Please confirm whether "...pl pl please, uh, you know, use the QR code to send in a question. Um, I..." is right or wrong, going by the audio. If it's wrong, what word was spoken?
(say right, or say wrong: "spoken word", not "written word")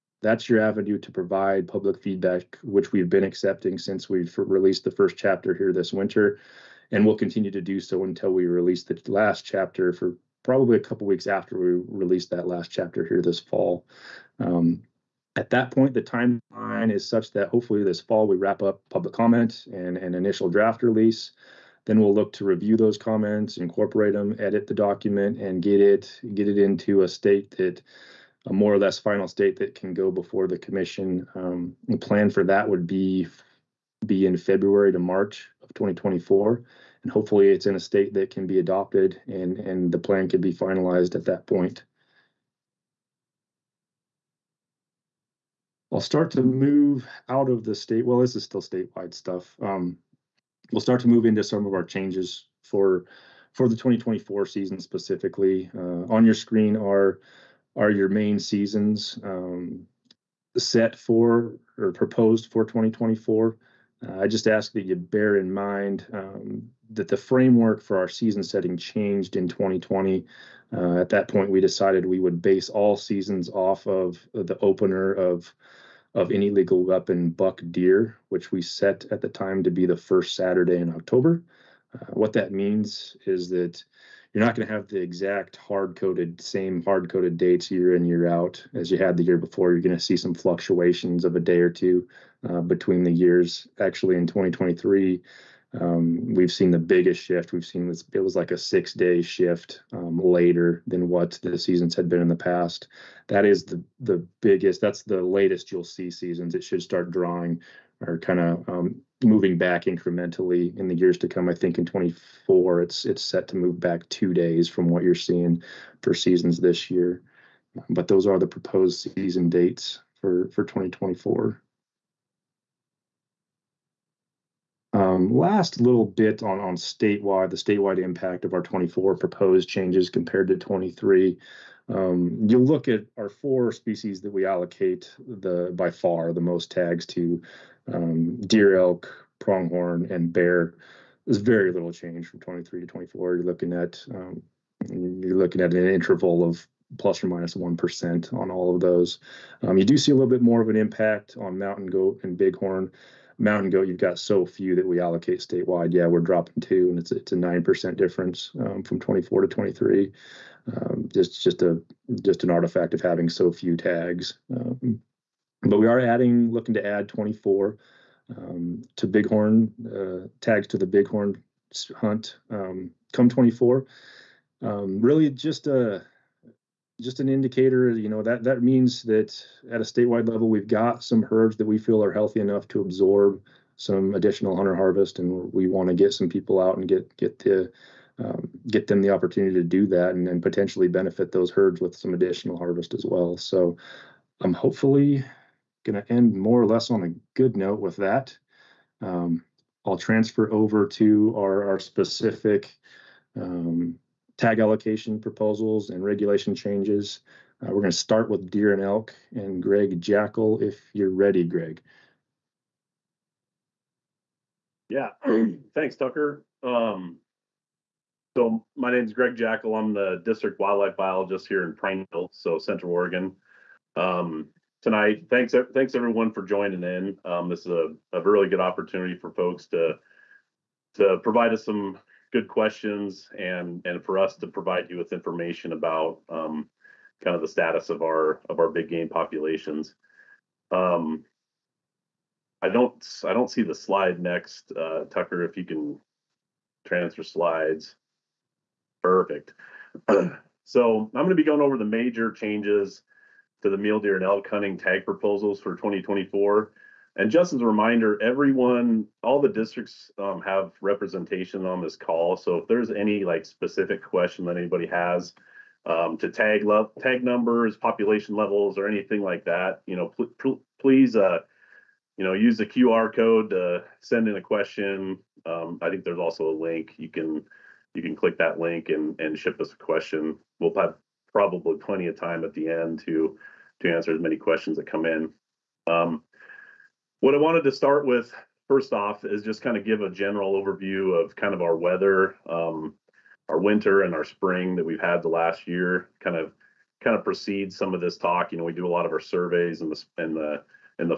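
right.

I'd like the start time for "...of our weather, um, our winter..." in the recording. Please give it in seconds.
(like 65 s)
291 s.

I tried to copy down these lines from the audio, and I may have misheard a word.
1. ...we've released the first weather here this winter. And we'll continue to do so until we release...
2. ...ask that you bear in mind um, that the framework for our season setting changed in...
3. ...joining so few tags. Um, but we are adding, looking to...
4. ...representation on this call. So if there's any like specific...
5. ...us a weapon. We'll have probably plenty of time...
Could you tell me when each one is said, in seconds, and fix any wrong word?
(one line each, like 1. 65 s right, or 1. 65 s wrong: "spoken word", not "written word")
1. 4 s wrong: "chapter", not "weather"
2. 64 s right
3. 163 s wrong: "having", not "joining"
4. 260 s right
5. 279 s wrong: "question", not "weapon".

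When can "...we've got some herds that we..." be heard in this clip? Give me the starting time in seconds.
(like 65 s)
180 s.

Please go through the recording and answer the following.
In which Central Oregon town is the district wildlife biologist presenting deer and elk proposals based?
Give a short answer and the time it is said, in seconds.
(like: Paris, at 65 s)
Prineville, at 221 s.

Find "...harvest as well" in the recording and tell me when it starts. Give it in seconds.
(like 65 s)
192 s.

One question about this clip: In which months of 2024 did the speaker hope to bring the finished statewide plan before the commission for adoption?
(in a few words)
February to March.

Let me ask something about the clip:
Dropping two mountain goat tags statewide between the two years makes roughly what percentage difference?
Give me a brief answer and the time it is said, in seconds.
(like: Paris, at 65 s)
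9%, at 157 s.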